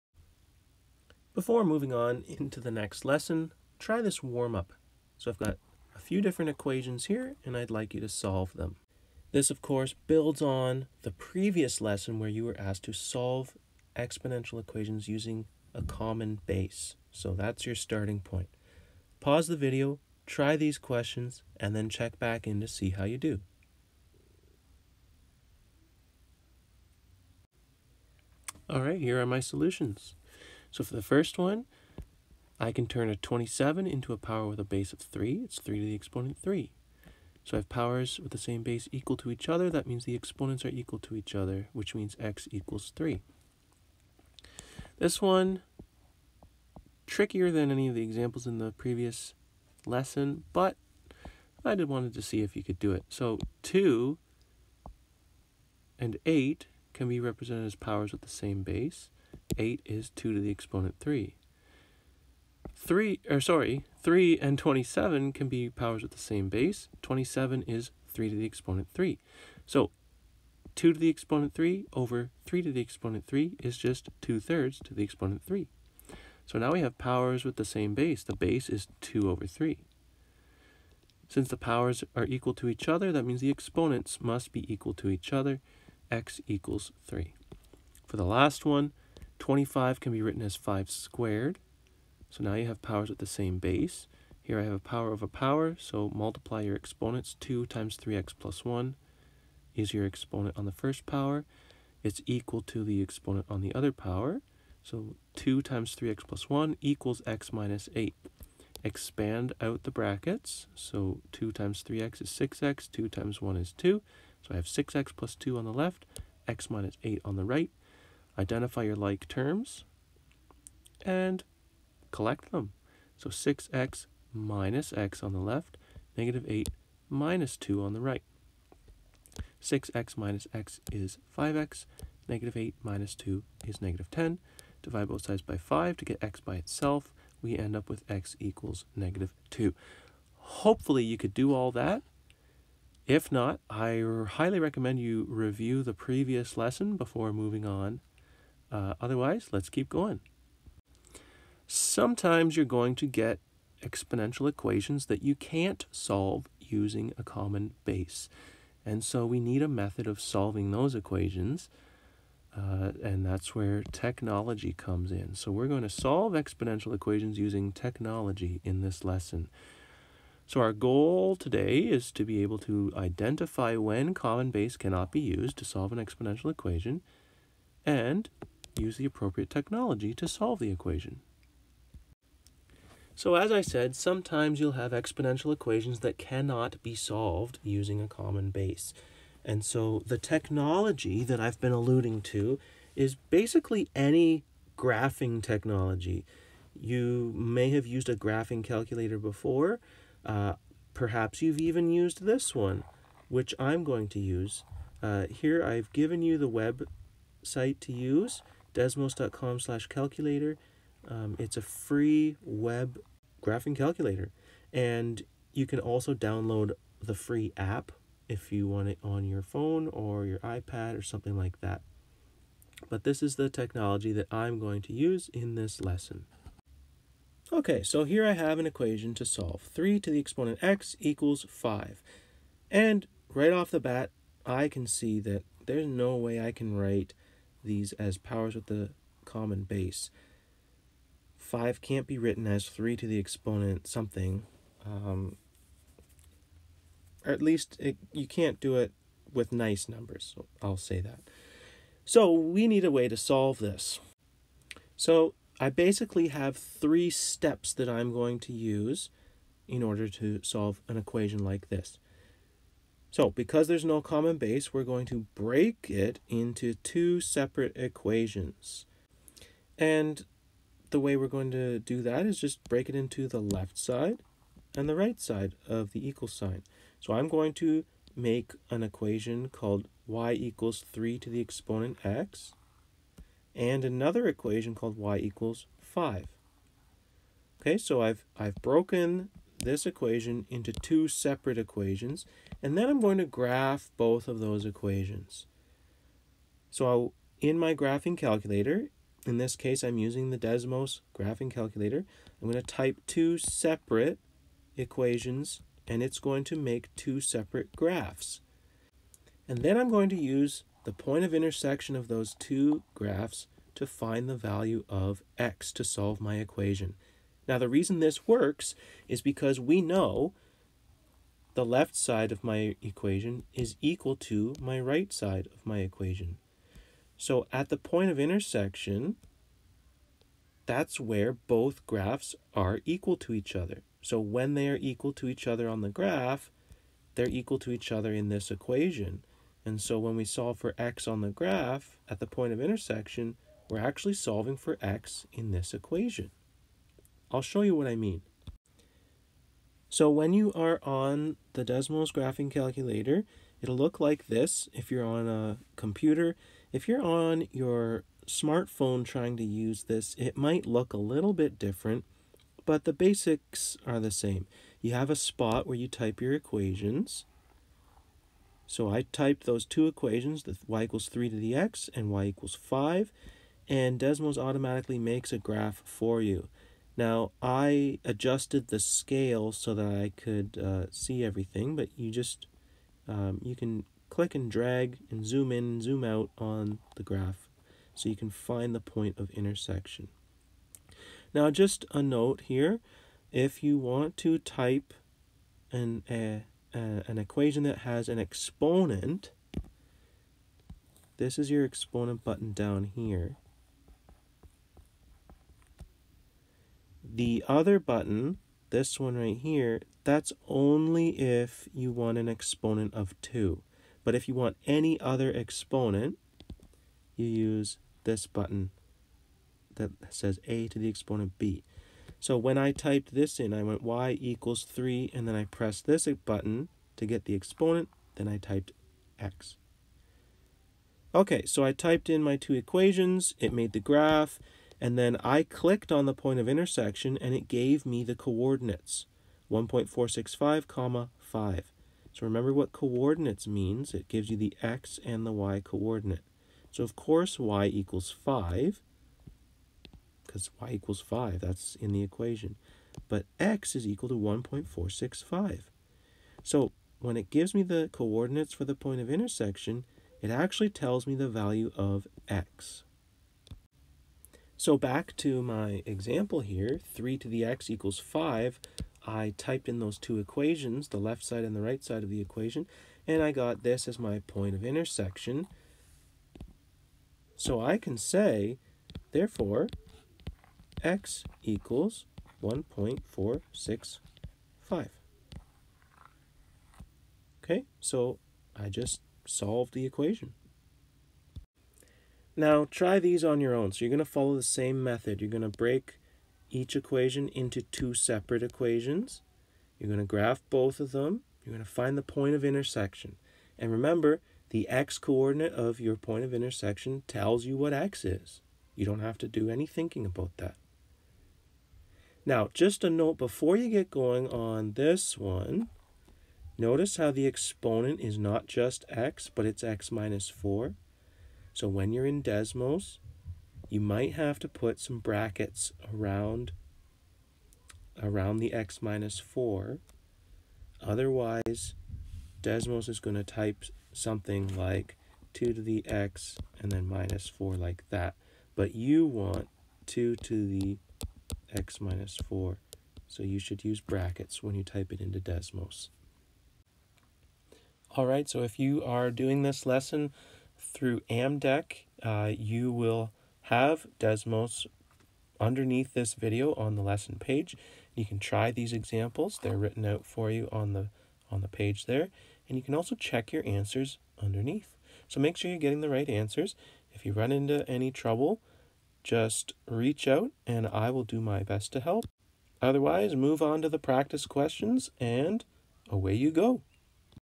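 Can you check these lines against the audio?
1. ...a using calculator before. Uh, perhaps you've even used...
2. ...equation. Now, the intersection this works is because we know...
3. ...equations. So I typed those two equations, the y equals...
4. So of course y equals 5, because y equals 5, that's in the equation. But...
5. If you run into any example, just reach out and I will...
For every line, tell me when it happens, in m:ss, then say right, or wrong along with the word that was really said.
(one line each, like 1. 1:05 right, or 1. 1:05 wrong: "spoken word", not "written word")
1. 3:18 wrong: "graphing", not "using"
2. 5:16 wrong: "reason", not "intersection"
3. 6:06 right
4. 7:26 right
5. 9:26 wrong: "trouble", not "example".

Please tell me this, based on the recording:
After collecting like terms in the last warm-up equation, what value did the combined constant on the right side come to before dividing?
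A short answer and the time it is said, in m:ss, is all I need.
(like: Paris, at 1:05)
-10, at 2:13.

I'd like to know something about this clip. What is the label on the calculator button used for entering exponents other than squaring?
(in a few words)
a to the exponent b.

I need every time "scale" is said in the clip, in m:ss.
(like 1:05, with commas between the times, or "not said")
6:18.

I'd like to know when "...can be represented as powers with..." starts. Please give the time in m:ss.
0:56.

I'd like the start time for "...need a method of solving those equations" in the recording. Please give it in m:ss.
2:39.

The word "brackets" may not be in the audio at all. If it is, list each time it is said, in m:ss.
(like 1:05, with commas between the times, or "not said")
1:49, 8:44, 9:03.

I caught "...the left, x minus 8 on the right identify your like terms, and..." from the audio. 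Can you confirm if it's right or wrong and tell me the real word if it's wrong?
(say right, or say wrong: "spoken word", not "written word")
right.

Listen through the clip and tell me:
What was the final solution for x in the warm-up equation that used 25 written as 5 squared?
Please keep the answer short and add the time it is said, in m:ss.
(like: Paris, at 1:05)
-2, at 2:18.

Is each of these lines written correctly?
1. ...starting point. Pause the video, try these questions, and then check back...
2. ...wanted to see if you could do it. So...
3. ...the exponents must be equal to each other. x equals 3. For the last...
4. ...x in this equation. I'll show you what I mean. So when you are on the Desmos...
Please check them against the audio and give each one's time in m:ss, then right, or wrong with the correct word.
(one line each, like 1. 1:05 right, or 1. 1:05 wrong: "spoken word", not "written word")
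1. 0:17 right
2. 0:51 right
3. 1:23 right
4. 5:44 right.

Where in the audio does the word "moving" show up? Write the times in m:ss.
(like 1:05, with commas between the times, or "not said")
0:01, 2:27.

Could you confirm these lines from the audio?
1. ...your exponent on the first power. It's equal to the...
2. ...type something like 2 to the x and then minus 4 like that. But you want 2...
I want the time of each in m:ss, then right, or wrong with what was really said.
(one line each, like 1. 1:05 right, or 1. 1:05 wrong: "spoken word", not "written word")
1. 1:39 right
2. 8:53 right.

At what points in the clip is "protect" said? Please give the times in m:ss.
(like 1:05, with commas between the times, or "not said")
not said.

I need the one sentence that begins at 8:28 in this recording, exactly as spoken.
You don't have to do any thinking about that.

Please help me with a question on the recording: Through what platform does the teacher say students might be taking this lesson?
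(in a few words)
Amdek.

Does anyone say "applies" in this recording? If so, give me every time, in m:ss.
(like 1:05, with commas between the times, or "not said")
not said.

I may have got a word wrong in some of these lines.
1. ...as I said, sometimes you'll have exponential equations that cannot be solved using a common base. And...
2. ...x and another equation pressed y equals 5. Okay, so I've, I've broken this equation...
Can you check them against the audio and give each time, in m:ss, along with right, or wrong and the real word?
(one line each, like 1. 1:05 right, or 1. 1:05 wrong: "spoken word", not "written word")
1. 3:03 right
2. 4:42 wrong: "called", not "pressed".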